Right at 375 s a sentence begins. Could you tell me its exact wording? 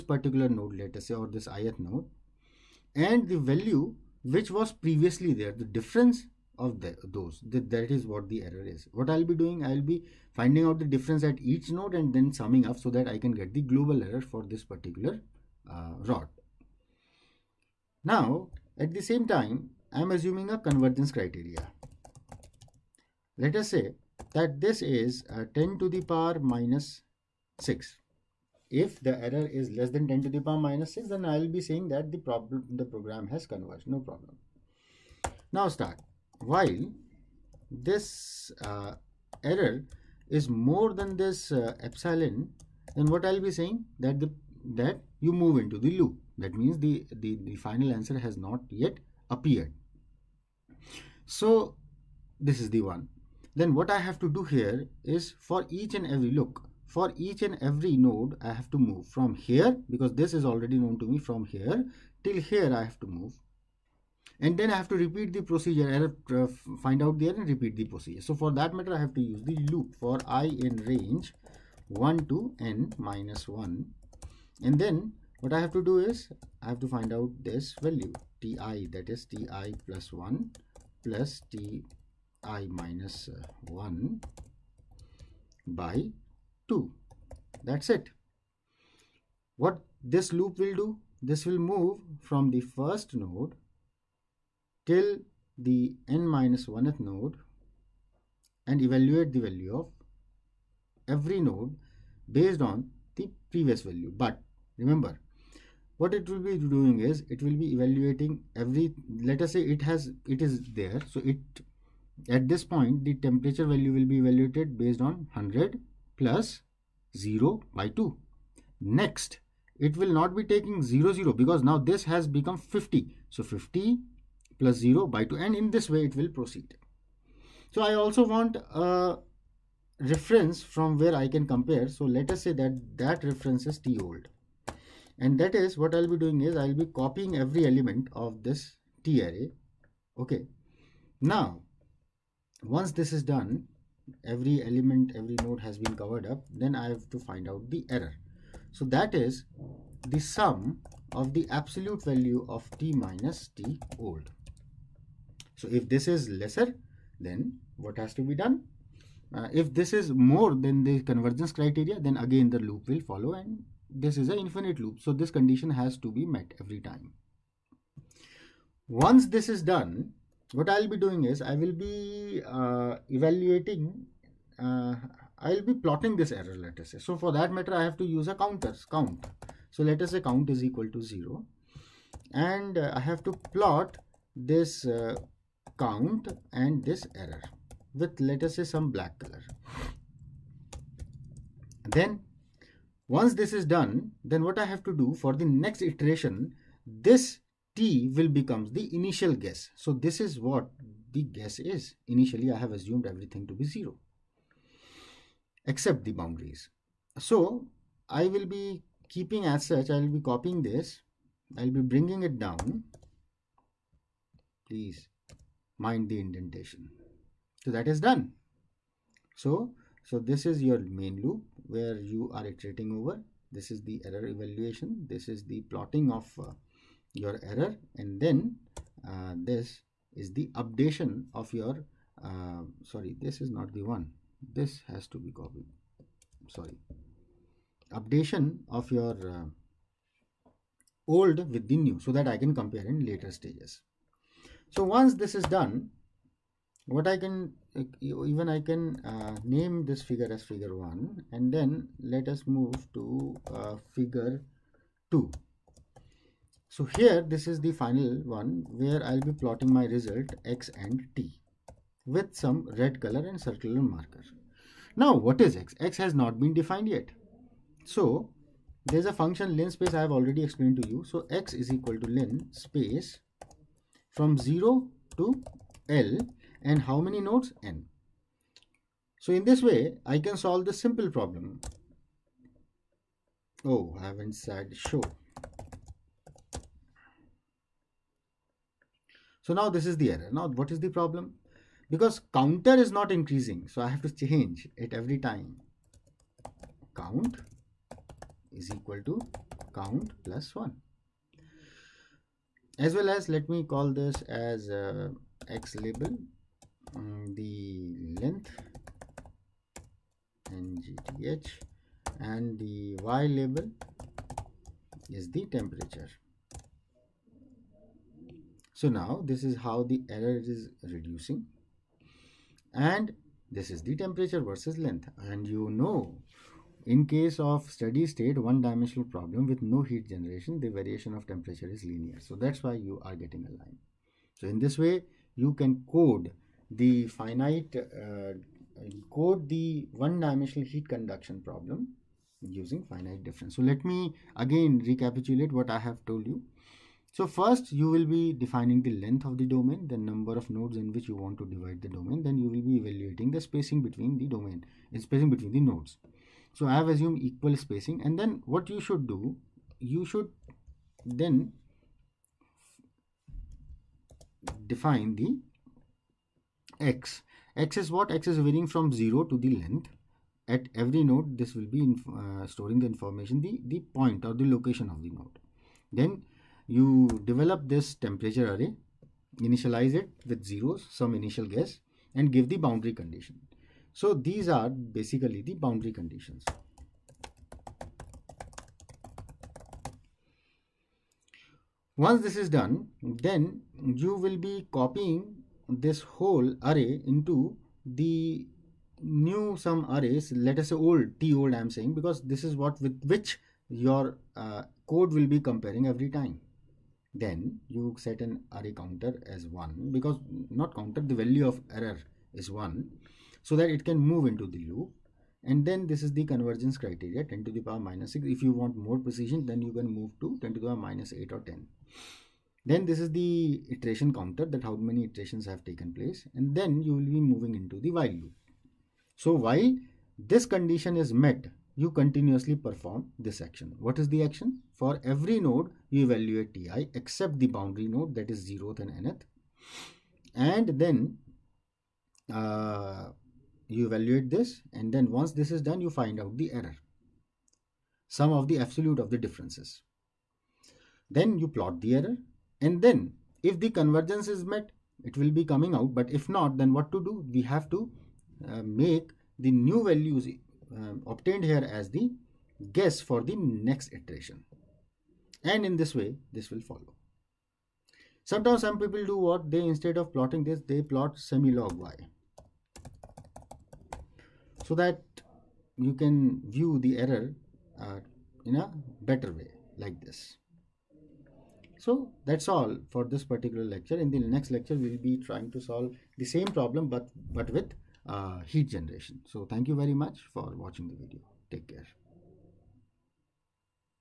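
Then you develop this temperature array, initialize it with zeros, some initial guess, and give the boundary condition.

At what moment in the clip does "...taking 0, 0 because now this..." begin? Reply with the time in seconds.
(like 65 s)
120 s.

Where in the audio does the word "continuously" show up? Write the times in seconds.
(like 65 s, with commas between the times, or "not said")
431 s.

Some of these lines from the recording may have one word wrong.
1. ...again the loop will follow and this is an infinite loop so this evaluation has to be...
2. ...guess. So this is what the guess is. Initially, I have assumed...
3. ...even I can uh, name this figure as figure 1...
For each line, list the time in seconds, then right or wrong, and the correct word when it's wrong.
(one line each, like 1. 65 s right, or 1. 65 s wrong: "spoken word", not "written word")
1. 162 s wrong: "condition", not "evaluation"
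2. 199 s right
3. 248 s right.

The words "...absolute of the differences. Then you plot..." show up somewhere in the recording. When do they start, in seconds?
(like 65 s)
448 s.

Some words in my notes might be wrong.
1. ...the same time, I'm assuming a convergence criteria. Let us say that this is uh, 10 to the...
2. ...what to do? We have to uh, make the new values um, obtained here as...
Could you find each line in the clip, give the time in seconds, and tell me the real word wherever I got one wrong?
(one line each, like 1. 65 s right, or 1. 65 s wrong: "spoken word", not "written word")
1. 18 s right
2. 456 s right.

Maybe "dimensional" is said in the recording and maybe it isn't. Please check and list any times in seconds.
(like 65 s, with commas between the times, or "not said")
328 s, 340 s.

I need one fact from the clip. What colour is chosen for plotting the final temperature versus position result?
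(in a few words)
Red.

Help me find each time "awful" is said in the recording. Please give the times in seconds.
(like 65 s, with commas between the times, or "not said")
not said.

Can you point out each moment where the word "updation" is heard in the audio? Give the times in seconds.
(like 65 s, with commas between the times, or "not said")
230 s, 237 s.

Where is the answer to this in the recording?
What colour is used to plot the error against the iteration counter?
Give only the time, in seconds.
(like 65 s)
188 s.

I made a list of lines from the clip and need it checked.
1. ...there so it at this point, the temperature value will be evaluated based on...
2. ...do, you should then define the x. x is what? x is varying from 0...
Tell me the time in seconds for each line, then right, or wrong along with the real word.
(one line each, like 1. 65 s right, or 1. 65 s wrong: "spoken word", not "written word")
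1. 110 s right
2. 359 s right.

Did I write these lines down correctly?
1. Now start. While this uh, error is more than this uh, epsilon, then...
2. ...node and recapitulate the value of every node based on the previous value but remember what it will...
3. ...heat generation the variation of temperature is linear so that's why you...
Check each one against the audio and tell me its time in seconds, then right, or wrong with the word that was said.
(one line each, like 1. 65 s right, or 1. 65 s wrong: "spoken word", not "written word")
1. 35 s right
2. 97 s wrong: "evaluate", not "recapitulate"
3. 329 s right.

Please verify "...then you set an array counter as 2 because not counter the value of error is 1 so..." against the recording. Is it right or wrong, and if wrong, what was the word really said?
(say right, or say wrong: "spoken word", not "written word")
wrong: "1", not "2".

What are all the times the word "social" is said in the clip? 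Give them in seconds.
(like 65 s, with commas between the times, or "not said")
not said.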